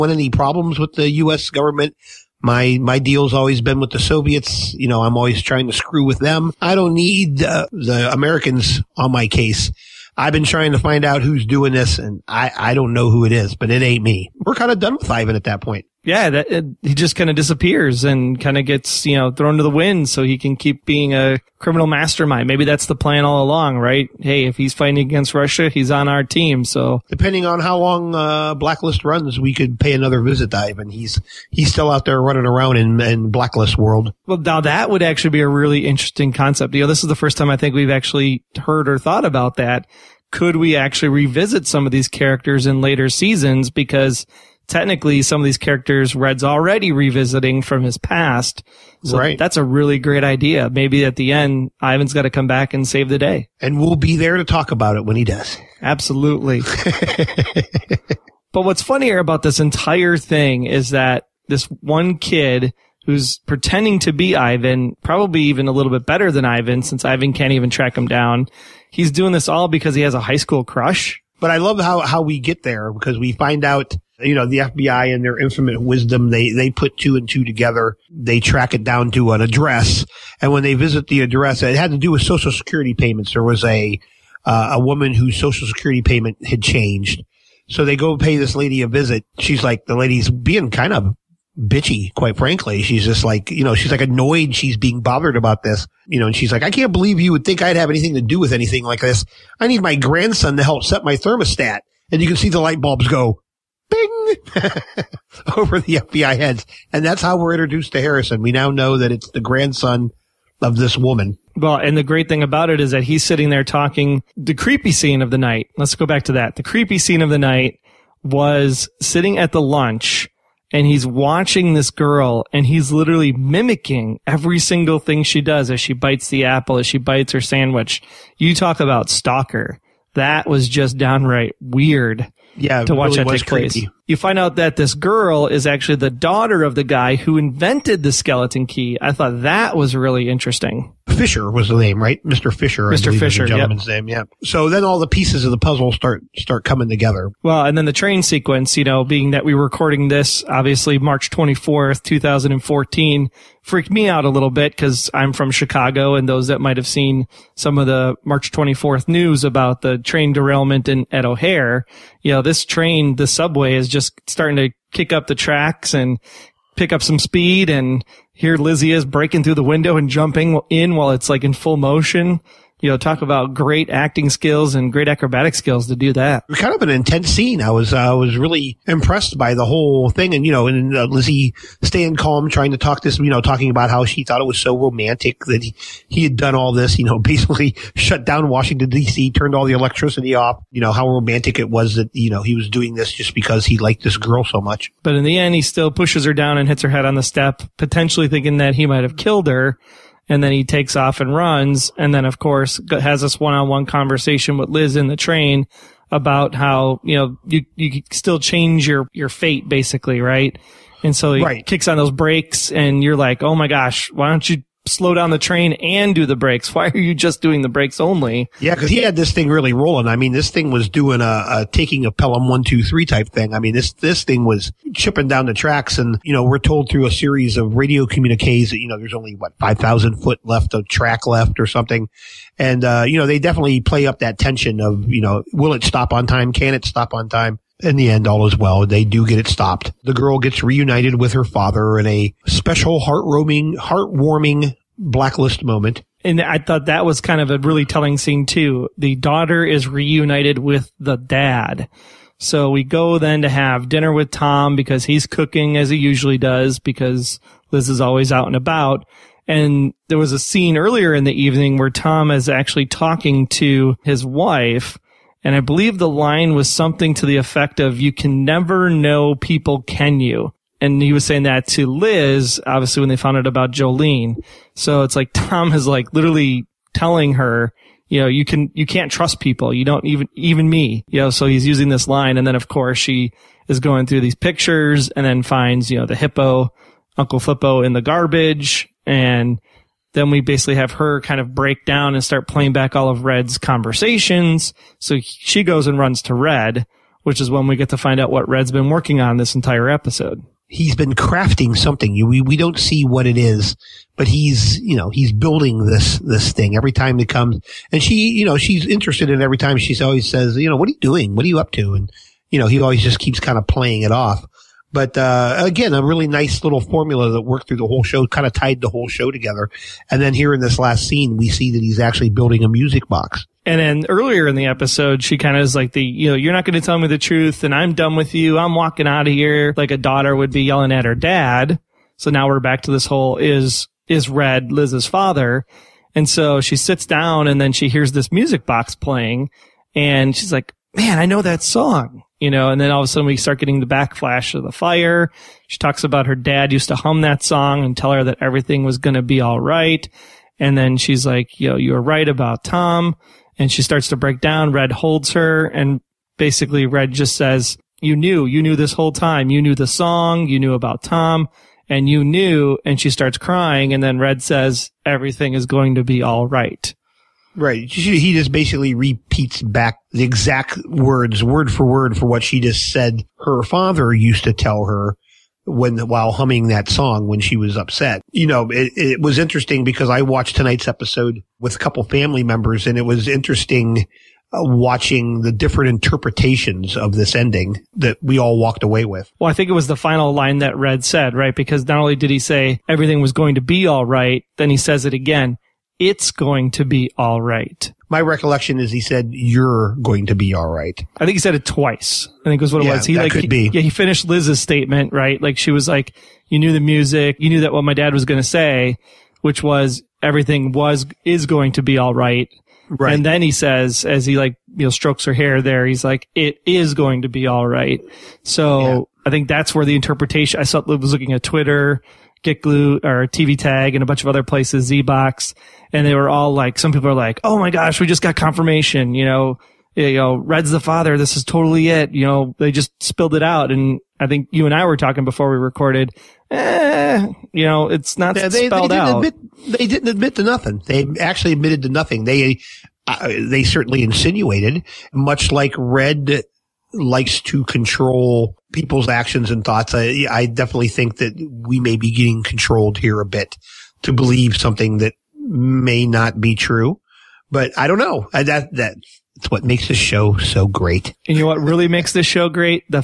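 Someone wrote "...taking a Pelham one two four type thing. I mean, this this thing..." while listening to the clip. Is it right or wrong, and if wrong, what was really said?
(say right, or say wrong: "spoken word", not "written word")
wrong: "three", not "four".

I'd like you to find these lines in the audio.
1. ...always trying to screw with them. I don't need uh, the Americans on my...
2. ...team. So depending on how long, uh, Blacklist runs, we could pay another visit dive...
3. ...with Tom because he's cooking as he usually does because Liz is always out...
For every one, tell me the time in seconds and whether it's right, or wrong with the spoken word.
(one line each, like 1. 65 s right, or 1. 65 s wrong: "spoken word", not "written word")
1. 5 s right
2. 26 s right
3. 254 s right.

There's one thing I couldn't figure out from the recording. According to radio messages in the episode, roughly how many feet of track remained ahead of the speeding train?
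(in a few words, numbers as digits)
5,000 feet.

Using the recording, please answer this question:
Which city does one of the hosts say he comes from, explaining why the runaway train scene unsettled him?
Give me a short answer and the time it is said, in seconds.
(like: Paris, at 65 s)
Chicago, at 155 s.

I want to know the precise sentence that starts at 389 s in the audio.
Well, I think it was the final line that Red said, right?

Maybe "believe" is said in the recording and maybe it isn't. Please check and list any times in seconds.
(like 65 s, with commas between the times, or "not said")
96 s, 265 s, 454 s.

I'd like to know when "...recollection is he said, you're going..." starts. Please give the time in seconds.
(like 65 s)
398 s.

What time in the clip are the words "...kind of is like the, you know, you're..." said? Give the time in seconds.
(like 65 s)
325 s.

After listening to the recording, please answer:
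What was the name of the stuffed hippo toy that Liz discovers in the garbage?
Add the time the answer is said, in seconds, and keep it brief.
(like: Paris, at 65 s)
Uncle Flippo, at 287 s.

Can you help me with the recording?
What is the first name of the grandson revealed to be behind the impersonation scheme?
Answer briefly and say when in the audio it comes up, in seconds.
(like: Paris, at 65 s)
Harrison, at 108 s.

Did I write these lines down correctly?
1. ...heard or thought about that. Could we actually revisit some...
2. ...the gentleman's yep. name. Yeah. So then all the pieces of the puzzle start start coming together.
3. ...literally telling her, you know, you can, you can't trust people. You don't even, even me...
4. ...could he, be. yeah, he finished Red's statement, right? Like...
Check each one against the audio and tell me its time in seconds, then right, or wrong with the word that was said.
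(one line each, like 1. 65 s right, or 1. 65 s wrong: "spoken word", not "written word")
1. 38 s right
2. 143 s right
3. 276 s right
4. 403 s wrong: "Liz", not "Red".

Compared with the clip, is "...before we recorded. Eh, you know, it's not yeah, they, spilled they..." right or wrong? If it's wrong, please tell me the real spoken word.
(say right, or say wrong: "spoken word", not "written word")
wrong: "spelled", not "spilled".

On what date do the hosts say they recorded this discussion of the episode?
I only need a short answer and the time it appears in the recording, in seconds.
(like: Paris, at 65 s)
March 24, 2014, at 150 s.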